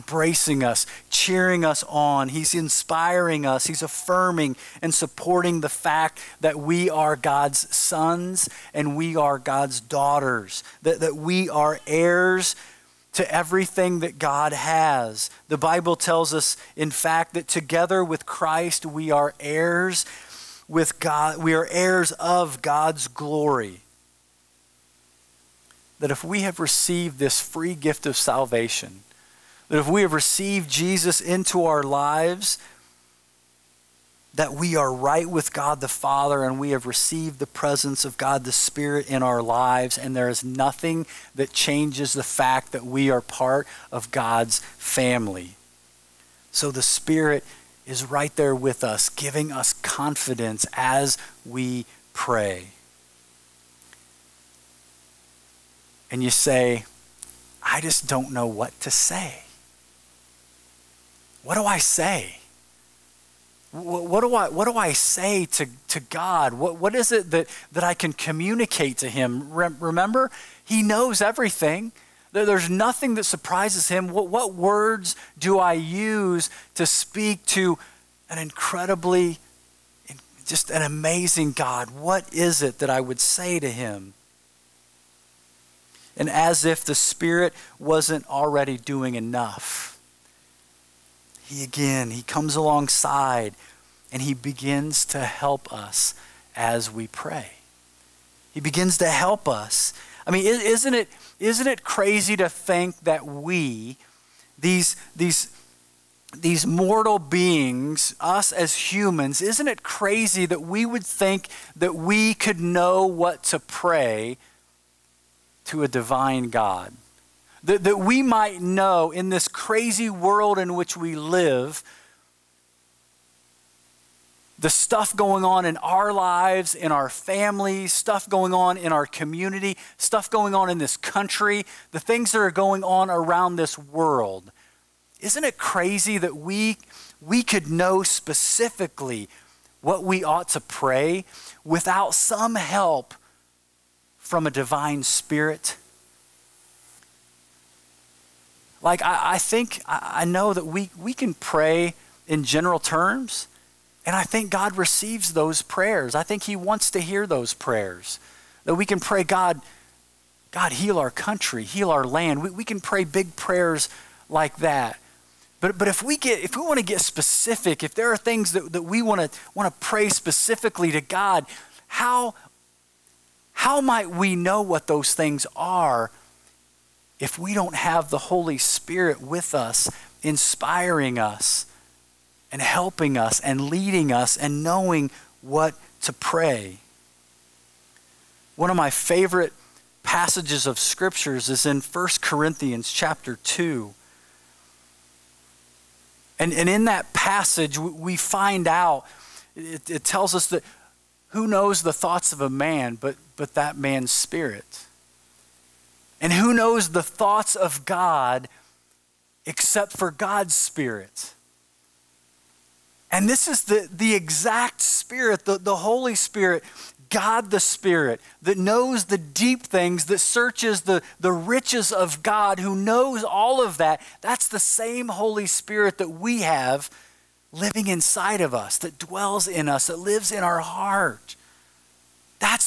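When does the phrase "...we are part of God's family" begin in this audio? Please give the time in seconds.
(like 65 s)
42 s.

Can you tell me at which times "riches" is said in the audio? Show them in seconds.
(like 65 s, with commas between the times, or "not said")
221 s.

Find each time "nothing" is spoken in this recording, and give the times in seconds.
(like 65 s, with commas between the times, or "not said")
40 s, 72 s.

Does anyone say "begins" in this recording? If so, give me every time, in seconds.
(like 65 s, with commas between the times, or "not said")
94 s, 98 s.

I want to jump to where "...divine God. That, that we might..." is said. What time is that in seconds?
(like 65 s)
115 s.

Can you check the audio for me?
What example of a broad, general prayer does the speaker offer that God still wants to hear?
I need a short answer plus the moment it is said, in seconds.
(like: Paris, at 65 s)
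Heal our land, at 161 s.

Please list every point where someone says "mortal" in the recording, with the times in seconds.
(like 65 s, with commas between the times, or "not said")
106 s.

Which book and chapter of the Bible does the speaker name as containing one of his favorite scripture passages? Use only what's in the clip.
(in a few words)
1 Corinthians 2.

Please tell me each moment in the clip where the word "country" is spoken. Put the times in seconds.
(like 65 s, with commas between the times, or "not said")
130 s, 161 s.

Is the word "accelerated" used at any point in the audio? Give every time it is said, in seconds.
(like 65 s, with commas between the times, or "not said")
not said.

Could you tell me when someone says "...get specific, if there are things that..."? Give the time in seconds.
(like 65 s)
166 s.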